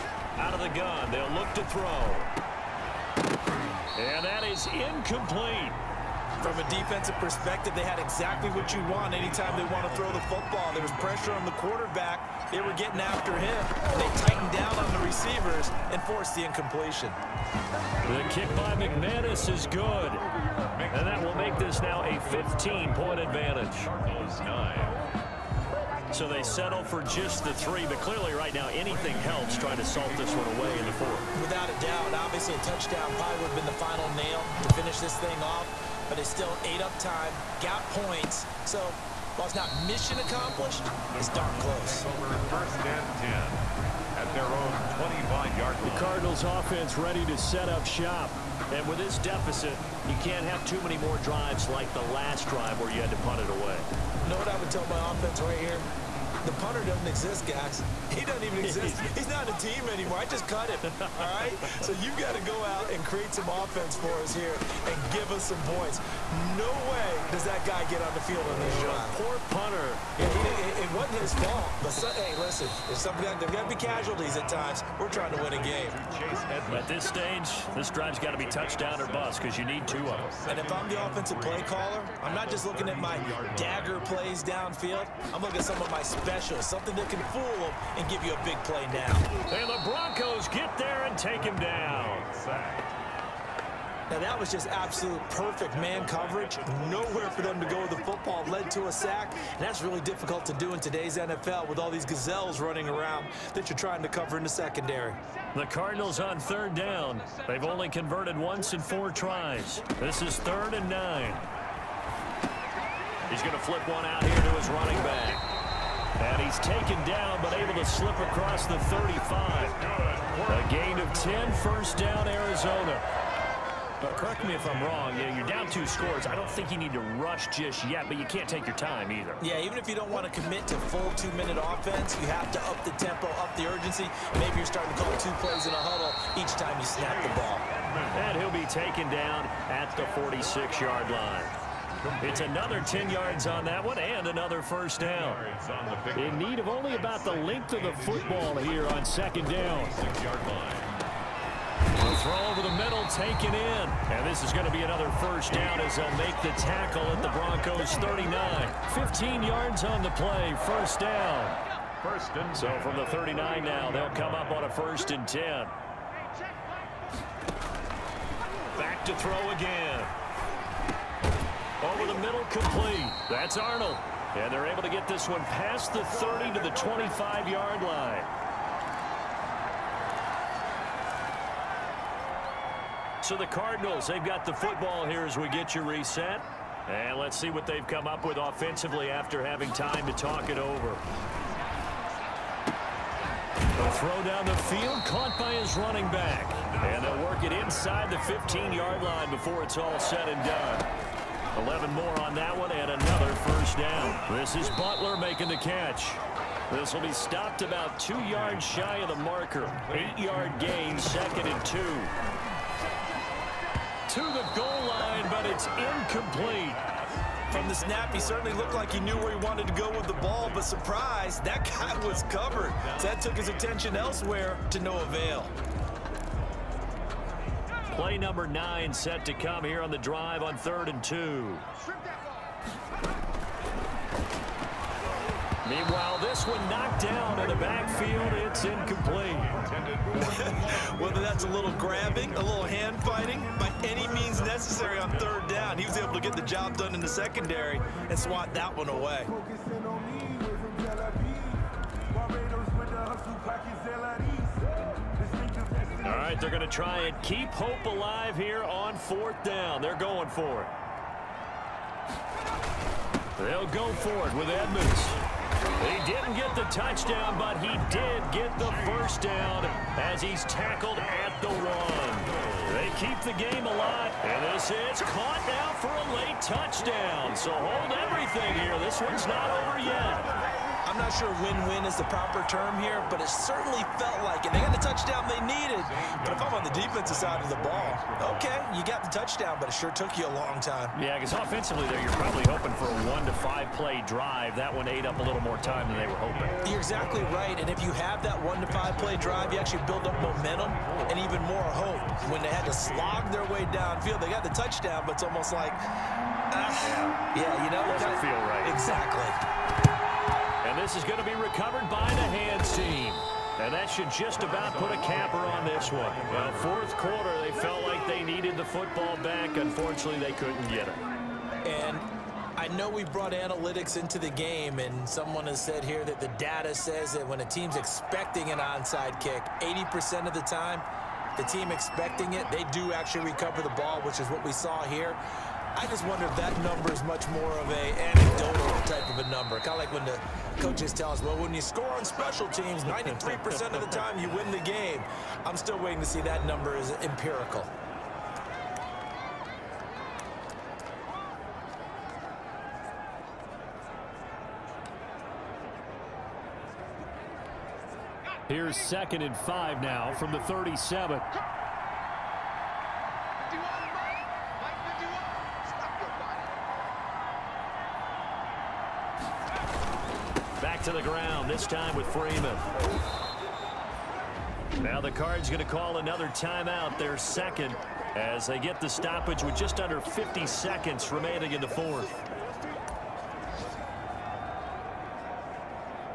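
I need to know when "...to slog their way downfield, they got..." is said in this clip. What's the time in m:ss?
5:02.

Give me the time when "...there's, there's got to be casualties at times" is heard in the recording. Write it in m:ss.
1:12.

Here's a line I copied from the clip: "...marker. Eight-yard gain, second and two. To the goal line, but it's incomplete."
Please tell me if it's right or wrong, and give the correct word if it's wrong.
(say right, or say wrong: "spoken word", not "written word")
right.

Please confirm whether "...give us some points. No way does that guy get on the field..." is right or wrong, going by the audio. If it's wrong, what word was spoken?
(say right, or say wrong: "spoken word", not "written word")
right.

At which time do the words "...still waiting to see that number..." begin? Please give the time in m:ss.
5:45.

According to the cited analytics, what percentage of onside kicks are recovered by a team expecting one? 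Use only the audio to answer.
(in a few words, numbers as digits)
80%.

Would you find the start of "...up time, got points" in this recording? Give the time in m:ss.
0:36.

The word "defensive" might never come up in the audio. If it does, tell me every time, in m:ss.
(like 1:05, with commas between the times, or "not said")
0:06, 4:46.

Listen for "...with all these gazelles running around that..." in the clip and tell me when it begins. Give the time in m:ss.
1:41.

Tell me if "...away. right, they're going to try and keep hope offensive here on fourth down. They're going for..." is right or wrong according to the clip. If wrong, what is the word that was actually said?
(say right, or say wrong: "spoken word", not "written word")
wrong: "alive", not "offensive".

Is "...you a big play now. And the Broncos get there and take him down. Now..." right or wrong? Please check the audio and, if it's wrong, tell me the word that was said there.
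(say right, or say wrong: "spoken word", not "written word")
right.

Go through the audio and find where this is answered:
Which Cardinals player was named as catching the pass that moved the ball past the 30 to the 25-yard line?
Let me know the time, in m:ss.
2:53.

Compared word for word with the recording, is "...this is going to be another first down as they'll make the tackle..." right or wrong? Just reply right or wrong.
right.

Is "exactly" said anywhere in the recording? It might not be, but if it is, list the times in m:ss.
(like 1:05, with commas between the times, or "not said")
0:07, 4:56, 5:08.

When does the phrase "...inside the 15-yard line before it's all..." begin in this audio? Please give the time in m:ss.
3:17.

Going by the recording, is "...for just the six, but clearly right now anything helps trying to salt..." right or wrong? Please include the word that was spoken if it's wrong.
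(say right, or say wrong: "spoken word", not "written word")
wrong: "three", not "six".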